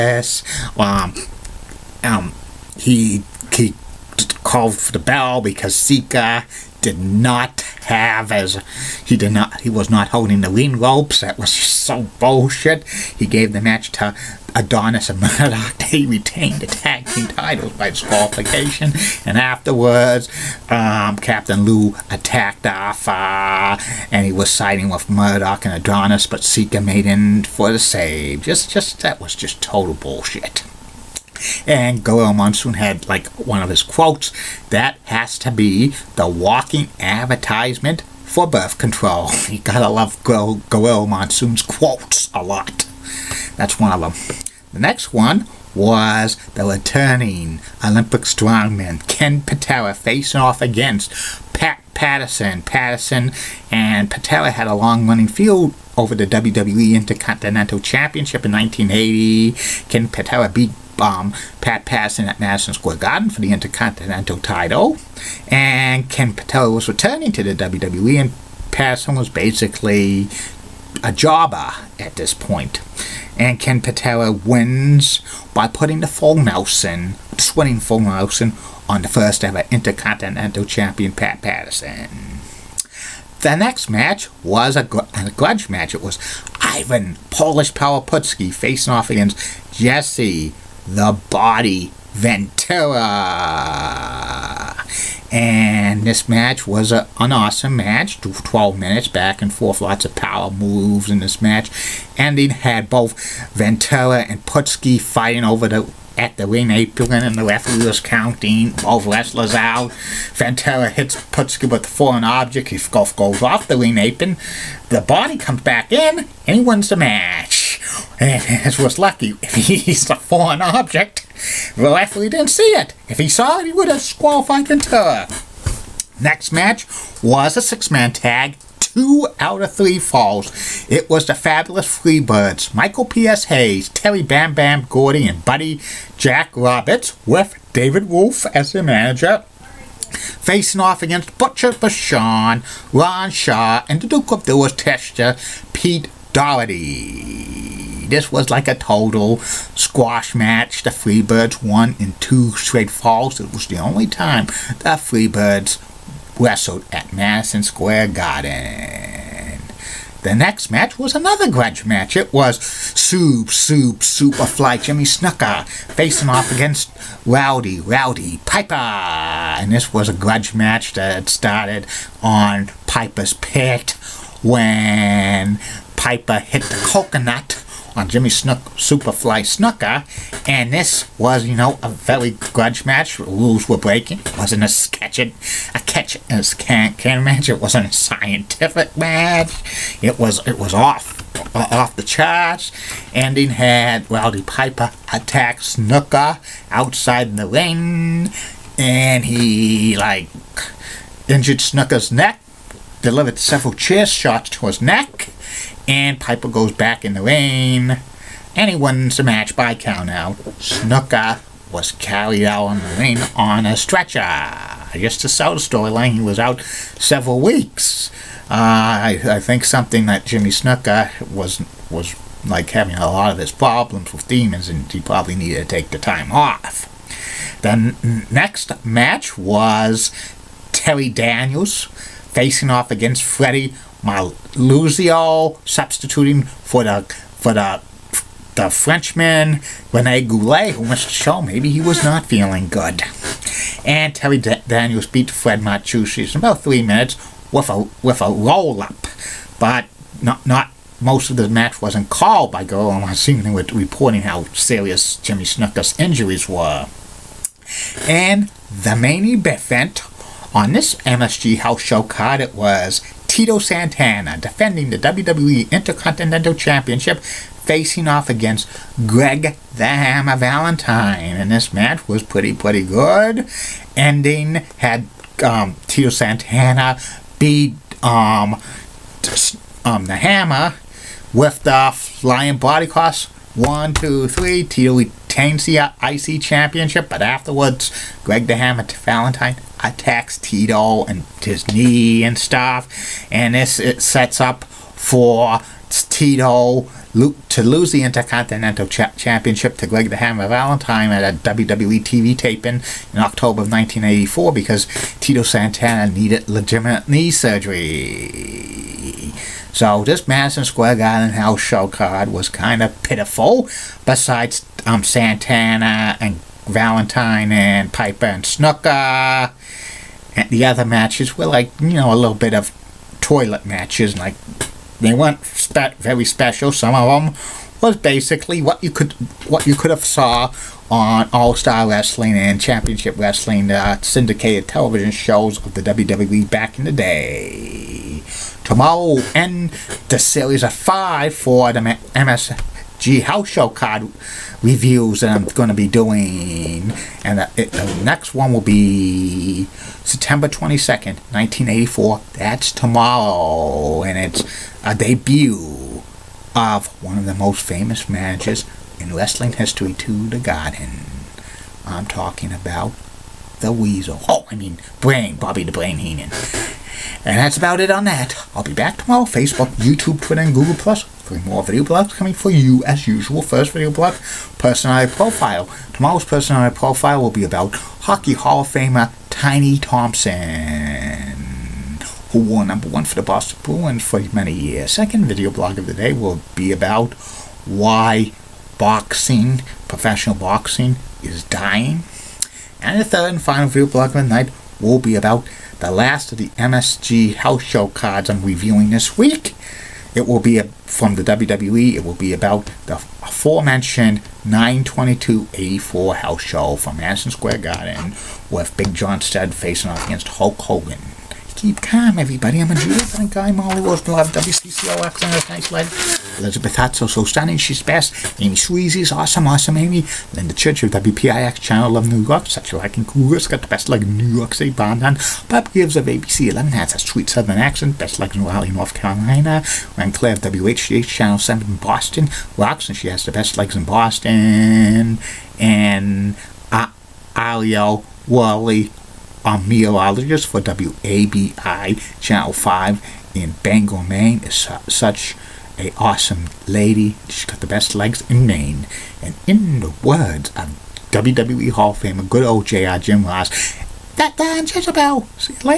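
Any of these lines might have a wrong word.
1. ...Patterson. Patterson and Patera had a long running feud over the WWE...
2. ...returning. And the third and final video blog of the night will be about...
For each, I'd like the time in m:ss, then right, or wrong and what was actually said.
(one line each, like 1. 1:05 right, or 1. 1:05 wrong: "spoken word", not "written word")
1. 0:51 right
2. 6:31 wrong: "dying", not "returning".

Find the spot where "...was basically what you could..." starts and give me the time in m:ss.
5:27.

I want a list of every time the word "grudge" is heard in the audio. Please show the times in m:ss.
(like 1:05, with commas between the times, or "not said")
1:25, 2:41, 2:50, 3:02.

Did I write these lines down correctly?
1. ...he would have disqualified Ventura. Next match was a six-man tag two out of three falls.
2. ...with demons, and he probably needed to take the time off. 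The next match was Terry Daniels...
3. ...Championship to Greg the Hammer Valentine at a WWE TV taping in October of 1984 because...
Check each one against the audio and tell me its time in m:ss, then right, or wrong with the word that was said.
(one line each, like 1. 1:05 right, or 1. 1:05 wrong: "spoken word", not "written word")
1. 2:03 right
2. 3:44 right
3. 4:58 right.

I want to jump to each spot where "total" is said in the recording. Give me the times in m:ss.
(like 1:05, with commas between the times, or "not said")
0:29, 2:28.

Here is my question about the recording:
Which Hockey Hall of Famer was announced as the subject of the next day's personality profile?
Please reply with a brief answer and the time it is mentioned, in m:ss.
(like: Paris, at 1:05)
Tiny Thompson, at 6:19.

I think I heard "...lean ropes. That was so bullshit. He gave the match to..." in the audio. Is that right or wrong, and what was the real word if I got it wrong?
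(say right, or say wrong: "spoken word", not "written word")
right.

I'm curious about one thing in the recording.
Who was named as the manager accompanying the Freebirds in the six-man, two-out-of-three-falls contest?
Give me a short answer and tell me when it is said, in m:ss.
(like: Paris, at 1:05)
David Wolf, at 2:17.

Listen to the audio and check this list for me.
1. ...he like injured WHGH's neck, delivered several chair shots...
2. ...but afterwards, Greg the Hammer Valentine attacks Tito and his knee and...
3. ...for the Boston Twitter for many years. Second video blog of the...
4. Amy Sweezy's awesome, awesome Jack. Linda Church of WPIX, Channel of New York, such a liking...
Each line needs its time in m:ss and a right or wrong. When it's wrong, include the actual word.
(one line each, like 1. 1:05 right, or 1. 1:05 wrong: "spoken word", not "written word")
1. 3:19 wrong: "Snuka", not "WHGH"
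2. 4:47 right
3. 6:23 wrong: "Bruins", not "Twitter"
4. 6:58 wrong: "Amy", not "Jack".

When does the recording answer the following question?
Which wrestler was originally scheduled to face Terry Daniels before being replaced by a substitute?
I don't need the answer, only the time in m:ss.
3:59.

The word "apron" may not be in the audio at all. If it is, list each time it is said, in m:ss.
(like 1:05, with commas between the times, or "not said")
1:46, 1:53.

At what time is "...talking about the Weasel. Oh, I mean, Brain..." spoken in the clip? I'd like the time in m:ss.
6:02.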